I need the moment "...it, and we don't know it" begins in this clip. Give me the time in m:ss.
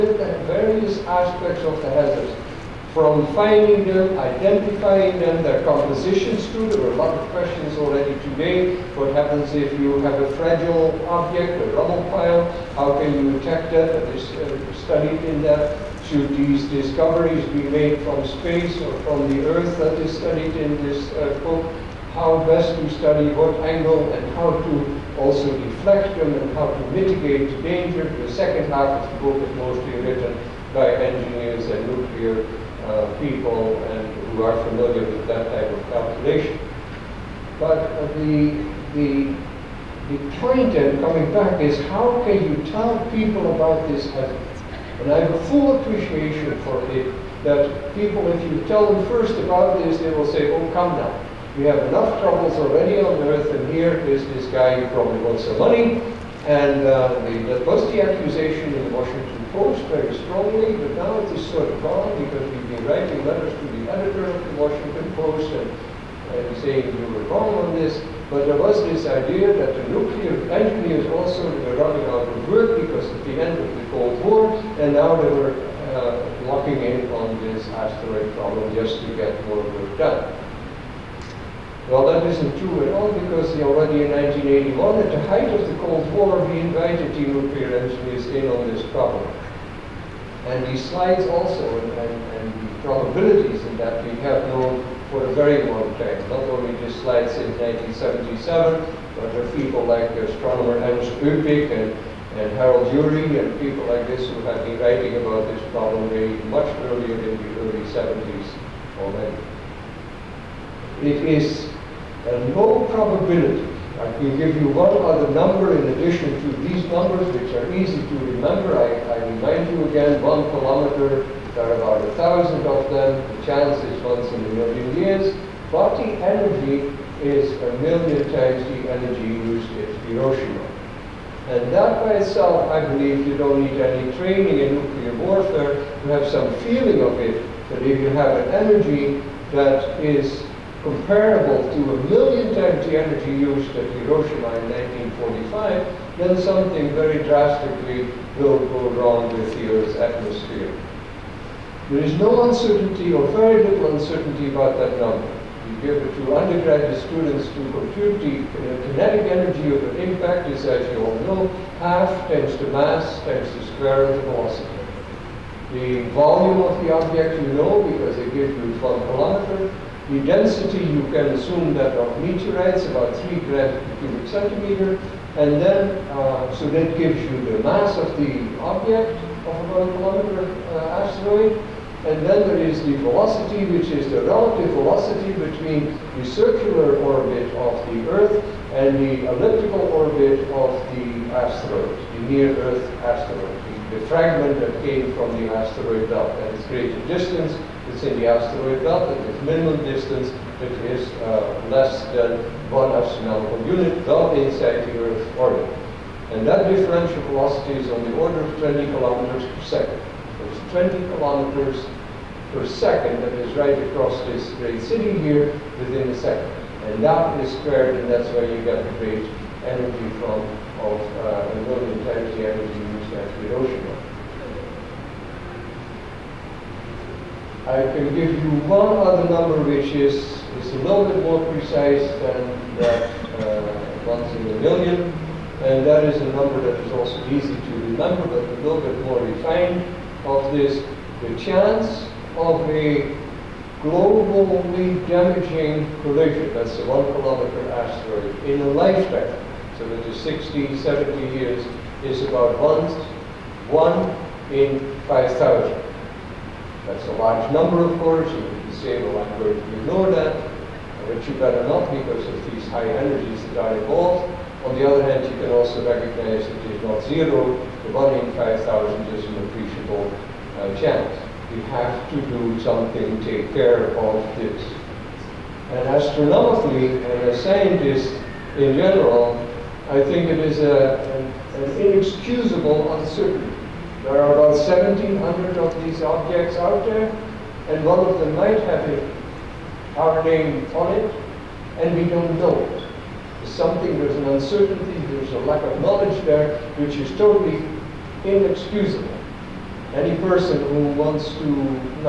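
4:50.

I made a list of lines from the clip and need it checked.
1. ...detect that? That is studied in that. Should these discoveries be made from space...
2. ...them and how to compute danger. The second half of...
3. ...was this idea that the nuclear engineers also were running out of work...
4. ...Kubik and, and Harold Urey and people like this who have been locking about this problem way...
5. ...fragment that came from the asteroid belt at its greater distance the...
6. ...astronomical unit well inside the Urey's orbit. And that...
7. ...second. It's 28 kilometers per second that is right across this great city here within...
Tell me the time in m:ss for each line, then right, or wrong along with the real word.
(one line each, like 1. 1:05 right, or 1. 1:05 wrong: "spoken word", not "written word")
1. 0:13 right
2. 0:26 wrong: "mitigate", not "compute"
3. 1:08 right
4. 1:41 wrong: "writing", not "locking"
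5. 3:14 right
6. 3:22 wrong: "Earth", not "Urey"
7. 3:29 wrong: "20", not "28".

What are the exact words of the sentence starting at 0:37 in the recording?
But uh, the, the, the point, in coming back, is how can you tell people about this hazard?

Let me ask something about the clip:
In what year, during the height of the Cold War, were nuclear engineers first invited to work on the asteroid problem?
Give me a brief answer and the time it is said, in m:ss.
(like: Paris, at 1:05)
1981, at 1:24.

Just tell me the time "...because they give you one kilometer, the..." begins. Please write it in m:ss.
2:47.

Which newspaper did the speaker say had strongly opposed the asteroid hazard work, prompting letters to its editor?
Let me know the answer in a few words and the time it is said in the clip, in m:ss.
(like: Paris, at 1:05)
Washington Post, at 1:04.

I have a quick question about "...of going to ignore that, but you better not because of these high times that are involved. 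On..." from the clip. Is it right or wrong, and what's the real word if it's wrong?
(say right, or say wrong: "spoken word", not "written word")
wrong: "energies", not "times".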